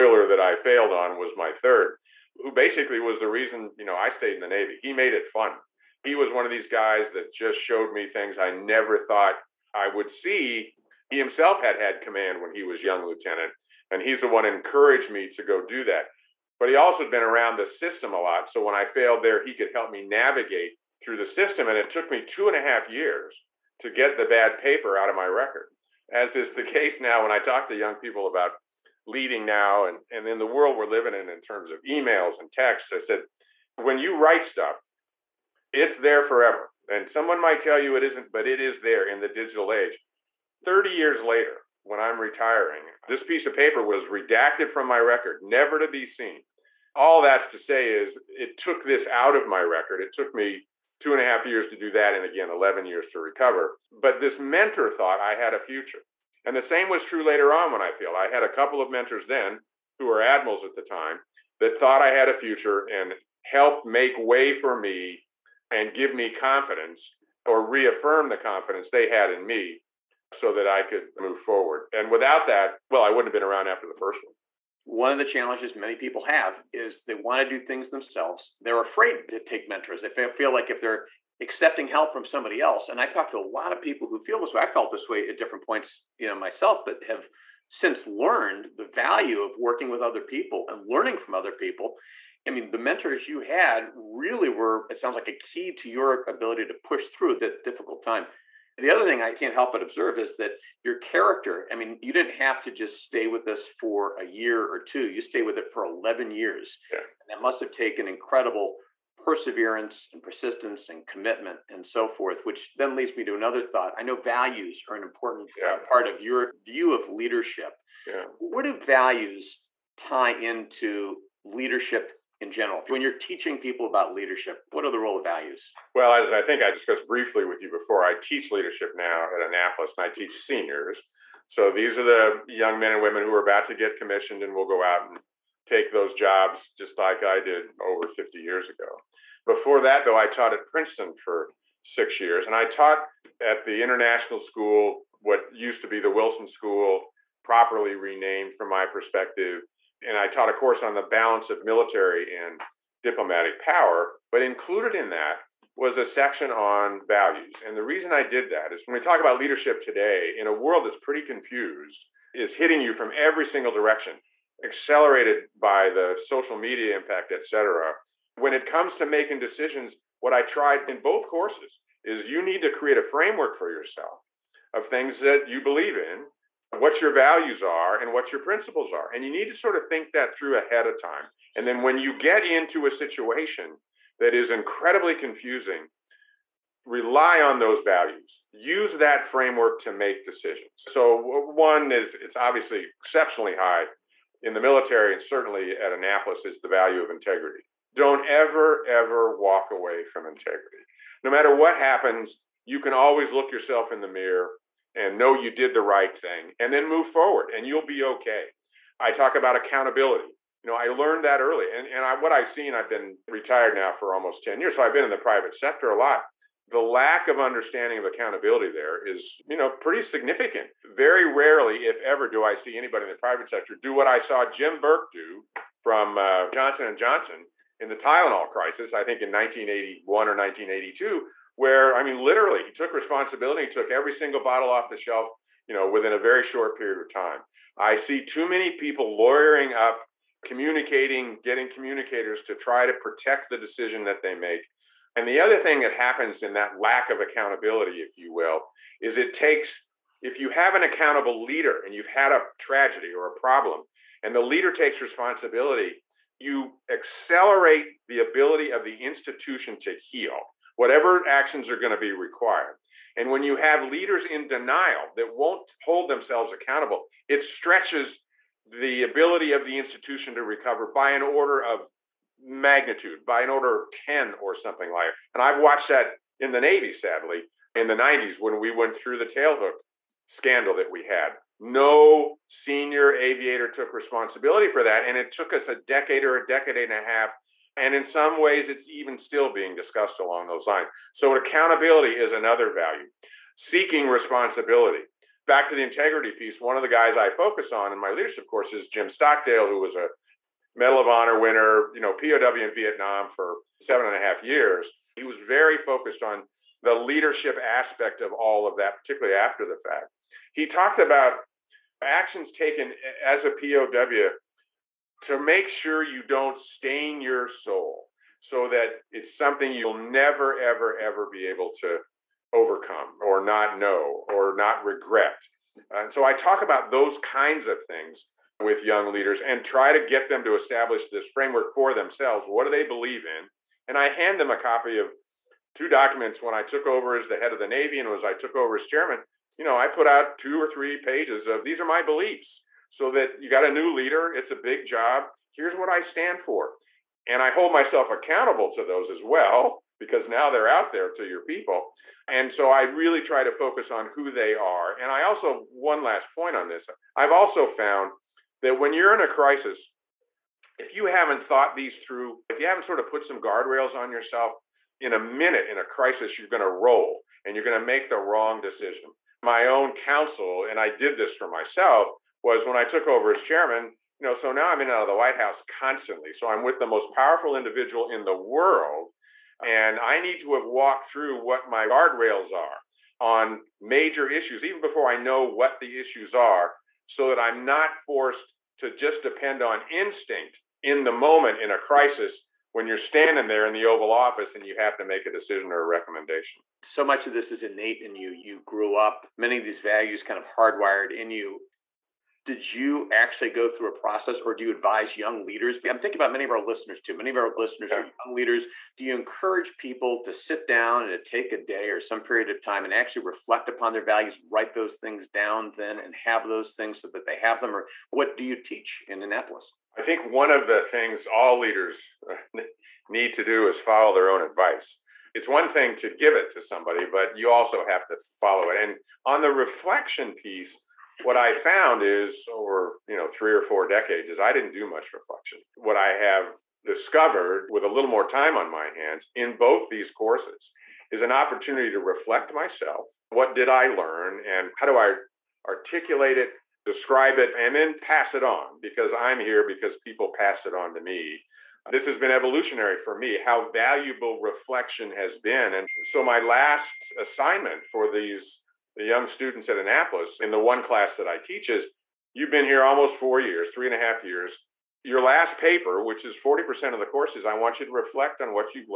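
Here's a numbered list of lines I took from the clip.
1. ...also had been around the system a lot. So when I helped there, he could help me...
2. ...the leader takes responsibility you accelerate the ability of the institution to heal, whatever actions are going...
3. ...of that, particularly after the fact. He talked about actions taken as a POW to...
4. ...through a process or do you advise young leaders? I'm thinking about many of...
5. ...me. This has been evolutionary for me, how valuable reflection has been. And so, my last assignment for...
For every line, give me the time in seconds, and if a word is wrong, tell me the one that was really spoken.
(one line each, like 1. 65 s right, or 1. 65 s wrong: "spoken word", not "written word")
1. 16 s wrong: "failed", not "helped"
2. 254 s right
3. 308 s right
4. 403 s right
5. 450 s right.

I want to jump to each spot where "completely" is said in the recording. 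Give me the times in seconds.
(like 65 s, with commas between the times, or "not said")
not said.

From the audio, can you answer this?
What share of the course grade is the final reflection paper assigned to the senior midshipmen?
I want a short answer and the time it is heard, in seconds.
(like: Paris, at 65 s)
40%, at 466 s.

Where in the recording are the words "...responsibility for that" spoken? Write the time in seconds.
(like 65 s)
283 s.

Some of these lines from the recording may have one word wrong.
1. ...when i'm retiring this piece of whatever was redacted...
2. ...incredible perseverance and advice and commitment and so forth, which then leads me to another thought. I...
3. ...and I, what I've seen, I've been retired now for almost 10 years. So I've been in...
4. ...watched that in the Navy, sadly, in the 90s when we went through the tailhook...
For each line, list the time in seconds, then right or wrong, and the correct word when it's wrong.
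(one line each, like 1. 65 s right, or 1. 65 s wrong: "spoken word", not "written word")
1. 41 s wrong: "paper", not "whatever"
2. 108 s wrong: "persistence", not "advice"
3. 211 s right
4. 275 s right.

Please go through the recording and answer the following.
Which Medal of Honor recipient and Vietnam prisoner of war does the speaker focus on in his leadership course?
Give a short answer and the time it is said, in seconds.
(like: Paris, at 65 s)
Jim Stockdale, at 298 s.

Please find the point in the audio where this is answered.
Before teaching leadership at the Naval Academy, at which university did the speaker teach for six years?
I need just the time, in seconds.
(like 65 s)
140 s.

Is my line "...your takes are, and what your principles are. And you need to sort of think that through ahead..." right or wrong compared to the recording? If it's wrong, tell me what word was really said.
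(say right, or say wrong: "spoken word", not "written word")
wrong: "values", not "takes".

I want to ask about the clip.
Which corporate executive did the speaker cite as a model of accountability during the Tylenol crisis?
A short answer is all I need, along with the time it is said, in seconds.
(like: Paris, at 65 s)
Jim Burke, at 224 s.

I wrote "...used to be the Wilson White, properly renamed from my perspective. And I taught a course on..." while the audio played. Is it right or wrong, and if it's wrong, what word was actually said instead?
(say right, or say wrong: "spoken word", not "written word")
wrong: "School", not "White".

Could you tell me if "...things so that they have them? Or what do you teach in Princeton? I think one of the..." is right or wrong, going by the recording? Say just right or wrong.
wrong.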